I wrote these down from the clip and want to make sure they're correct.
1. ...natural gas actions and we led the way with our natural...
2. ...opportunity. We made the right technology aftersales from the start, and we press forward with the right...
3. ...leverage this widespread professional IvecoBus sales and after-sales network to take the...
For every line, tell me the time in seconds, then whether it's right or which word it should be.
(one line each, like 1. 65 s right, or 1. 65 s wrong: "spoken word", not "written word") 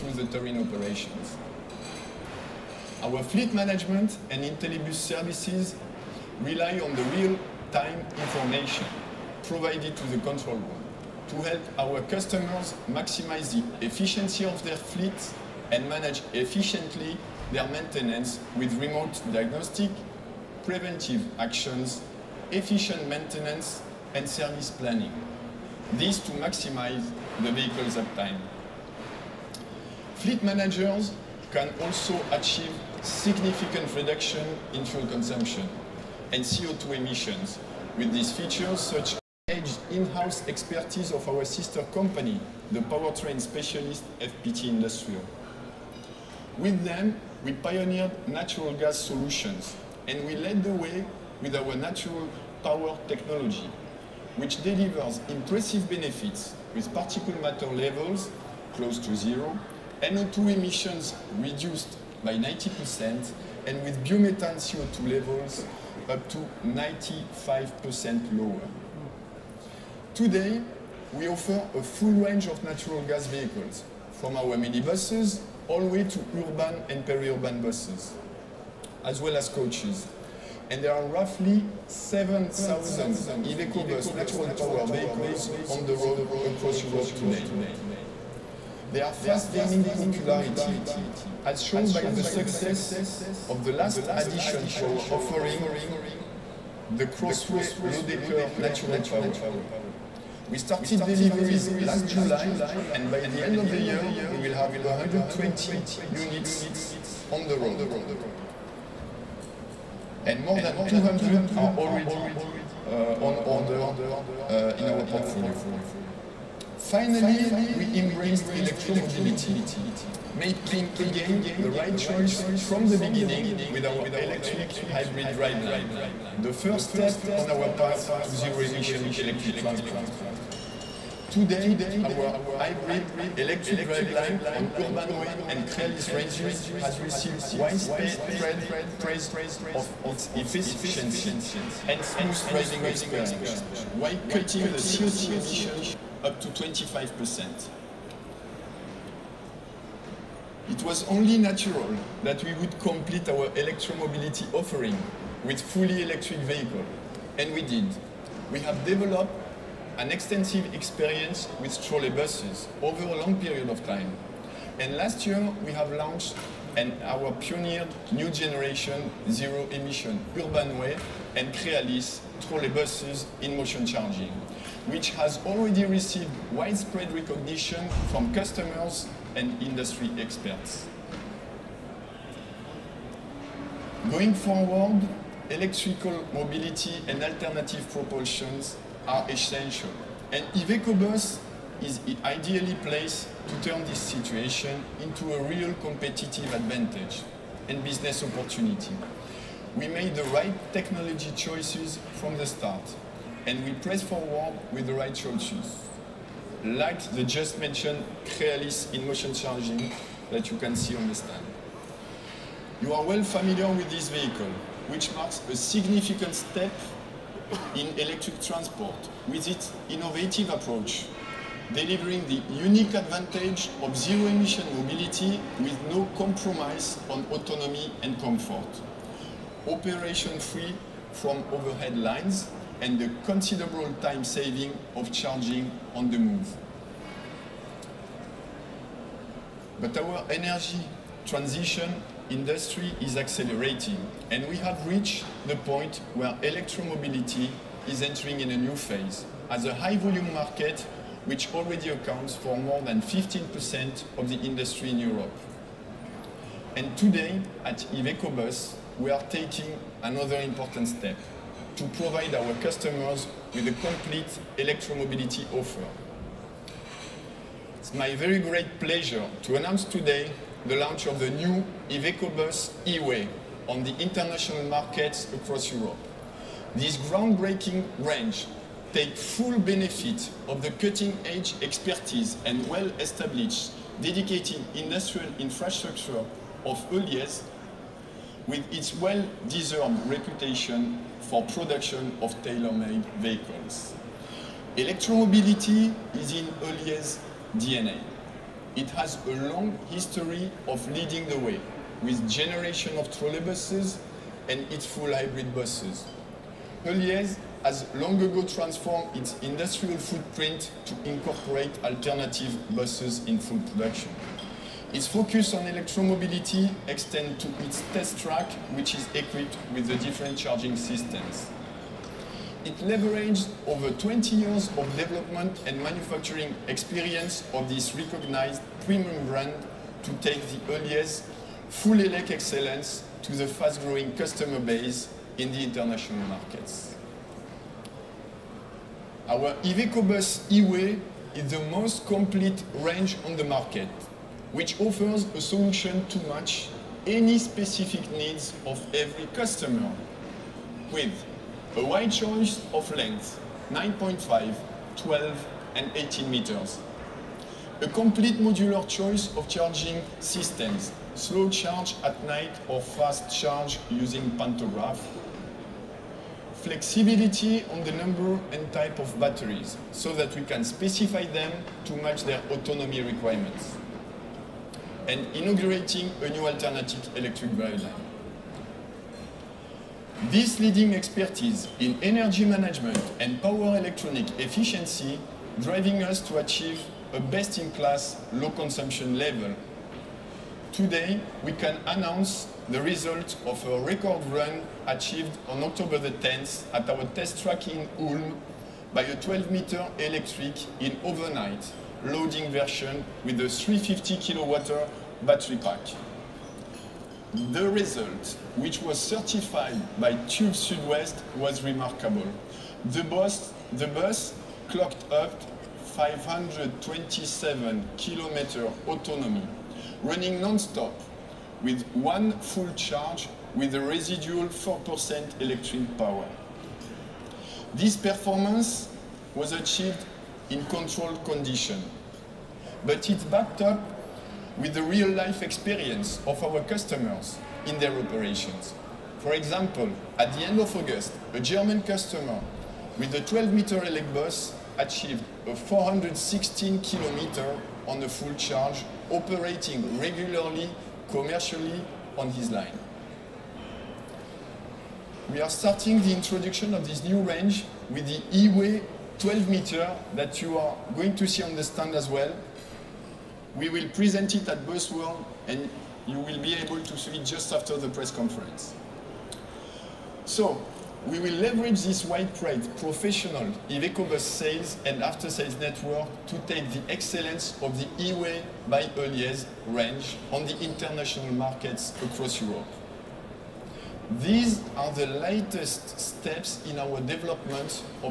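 1. 48 s wrong: "solutions", not "actions"
2. 198 s wrong: "choices", not "aftersales"
3. 471 s right.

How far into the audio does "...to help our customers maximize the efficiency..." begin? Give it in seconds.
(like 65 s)
11 s.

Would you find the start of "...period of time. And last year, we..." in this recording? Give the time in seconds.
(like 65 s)
163 s.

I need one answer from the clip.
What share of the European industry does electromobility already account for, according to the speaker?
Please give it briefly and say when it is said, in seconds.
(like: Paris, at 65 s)
More than 15%, at 252 s.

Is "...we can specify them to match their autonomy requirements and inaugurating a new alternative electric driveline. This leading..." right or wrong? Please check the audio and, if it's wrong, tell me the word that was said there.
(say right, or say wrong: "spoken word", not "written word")
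right.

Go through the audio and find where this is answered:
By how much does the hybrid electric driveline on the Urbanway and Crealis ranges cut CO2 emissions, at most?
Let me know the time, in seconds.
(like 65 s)
146 s.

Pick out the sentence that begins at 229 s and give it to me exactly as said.
Operation free from overhead lines and the considerable time saving of charging on the move.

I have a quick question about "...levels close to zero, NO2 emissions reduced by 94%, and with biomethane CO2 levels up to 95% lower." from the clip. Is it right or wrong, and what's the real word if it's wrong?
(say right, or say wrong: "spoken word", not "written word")
wrong: "90", not "94".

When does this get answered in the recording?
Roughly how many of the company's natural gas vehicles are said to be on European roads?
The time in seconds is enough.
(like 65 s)
81 s.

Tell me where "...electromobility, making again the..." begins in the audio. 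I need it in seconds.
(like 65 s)
118 s.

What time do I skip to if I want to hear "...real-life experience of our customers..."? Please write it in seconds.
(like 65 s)
434 s.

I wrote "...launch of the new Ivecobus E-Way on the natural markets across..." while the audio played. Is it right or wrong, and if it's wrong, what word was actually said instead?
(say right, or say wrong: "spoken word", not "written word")
wrong: "international", not "natural".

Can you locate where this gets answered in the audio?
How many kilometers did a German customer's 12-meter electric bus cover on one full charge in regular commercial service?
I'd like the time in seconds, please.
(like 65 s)
445 s.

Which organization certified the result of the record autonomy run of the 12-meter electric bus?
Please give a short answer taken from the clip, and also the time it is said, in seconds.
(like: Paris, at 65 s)
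TÜV Sudwest, at 410 s.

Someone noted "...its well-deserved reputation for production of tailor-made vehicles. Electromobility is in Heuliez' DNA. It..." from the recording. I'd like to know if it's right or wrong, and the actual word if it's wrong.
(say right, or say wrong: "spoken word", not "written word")
right.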